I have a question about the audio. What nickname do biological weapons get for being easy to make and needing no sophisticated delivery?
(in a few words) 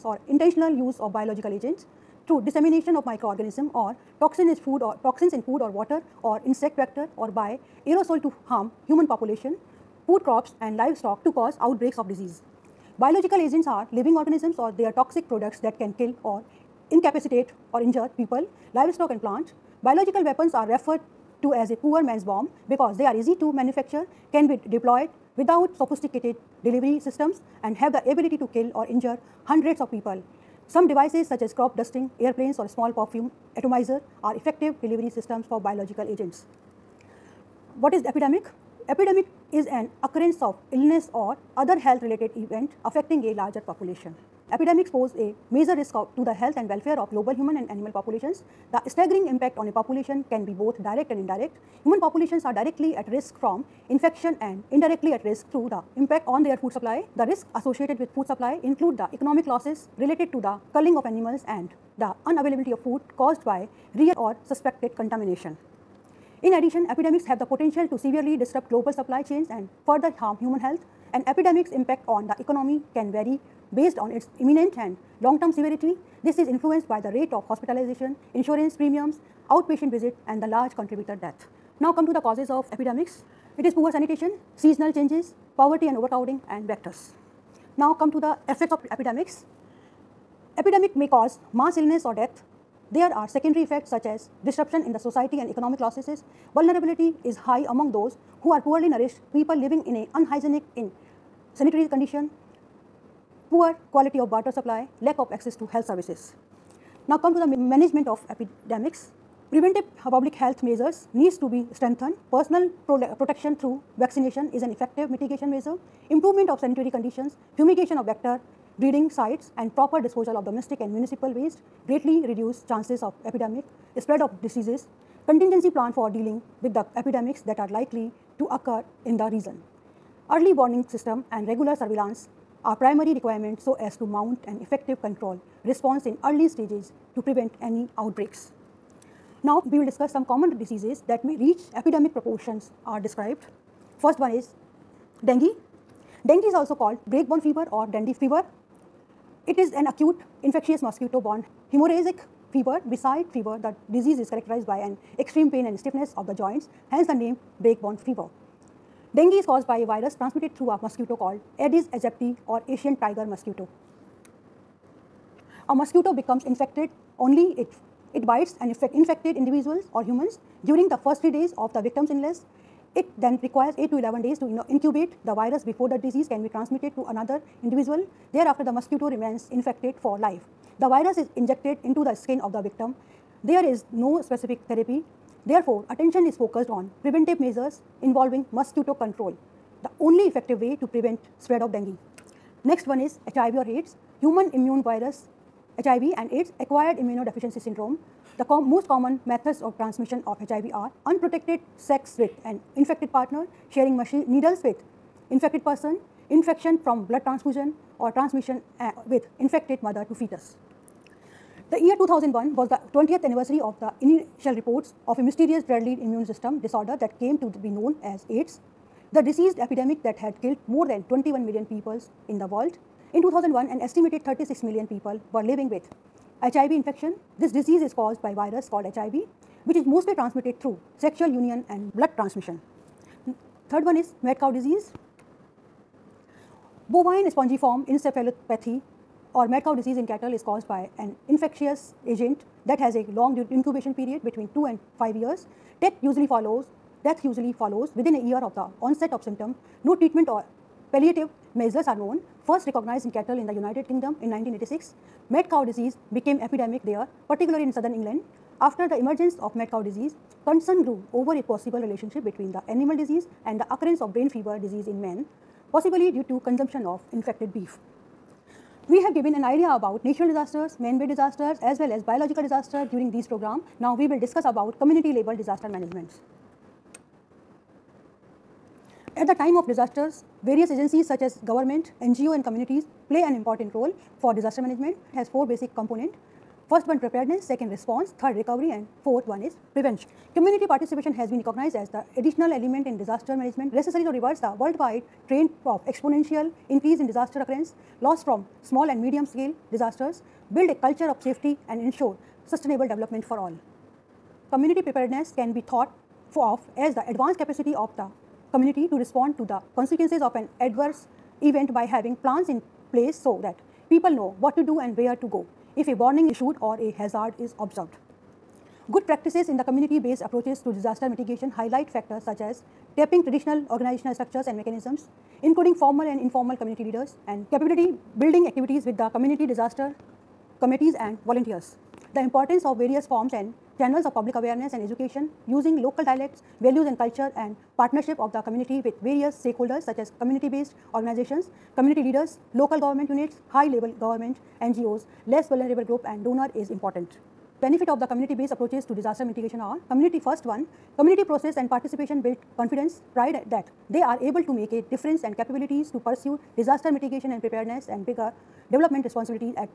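poor man's bomb.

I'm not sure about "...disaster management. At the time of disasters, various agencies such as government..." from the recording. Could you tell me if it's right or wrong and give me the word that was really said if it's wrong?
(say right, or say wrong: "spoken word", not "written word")
right.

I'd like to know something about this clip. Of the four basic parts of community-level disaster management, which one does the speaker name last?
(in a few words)
Prevention.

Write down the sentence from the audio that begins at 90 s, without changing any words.
Epidemic may cause mass illness or death there are secondary effects such as disruption in the society and economic losses.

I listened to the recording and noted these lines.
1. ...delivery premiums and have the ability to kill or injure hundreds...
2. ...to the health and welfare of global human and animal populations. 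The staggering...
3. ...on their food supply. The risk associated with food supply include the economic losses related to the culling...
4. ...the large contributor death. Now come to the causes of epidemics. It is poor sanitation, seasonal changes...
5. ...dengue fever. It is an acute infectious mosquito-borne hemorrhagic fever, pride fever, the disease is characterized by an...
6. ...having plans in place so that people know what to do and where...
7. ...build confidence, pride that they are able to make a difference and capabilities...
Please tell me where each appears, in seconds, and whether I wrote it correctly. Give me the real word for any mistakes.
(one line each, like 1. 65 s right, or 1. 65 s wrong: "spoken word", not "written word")
1. 26 s wrong: "systems", not "premiums"
2. 46 s right
3. 56 s right
4. 80 s right
5. 147 s wrong: "beside", not "pride"
6. 311 s right
7. 352 s right.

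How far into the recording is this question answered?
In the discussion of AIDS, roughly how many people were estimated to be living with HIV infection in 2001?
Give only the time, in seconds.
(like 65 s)
224 s.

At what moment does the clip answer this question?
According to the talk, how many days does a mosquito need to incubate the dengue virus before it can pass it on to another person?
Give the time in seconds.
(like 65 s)
173 s.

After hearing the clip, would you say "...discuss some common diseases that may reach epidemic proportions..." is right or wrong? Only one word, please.
right.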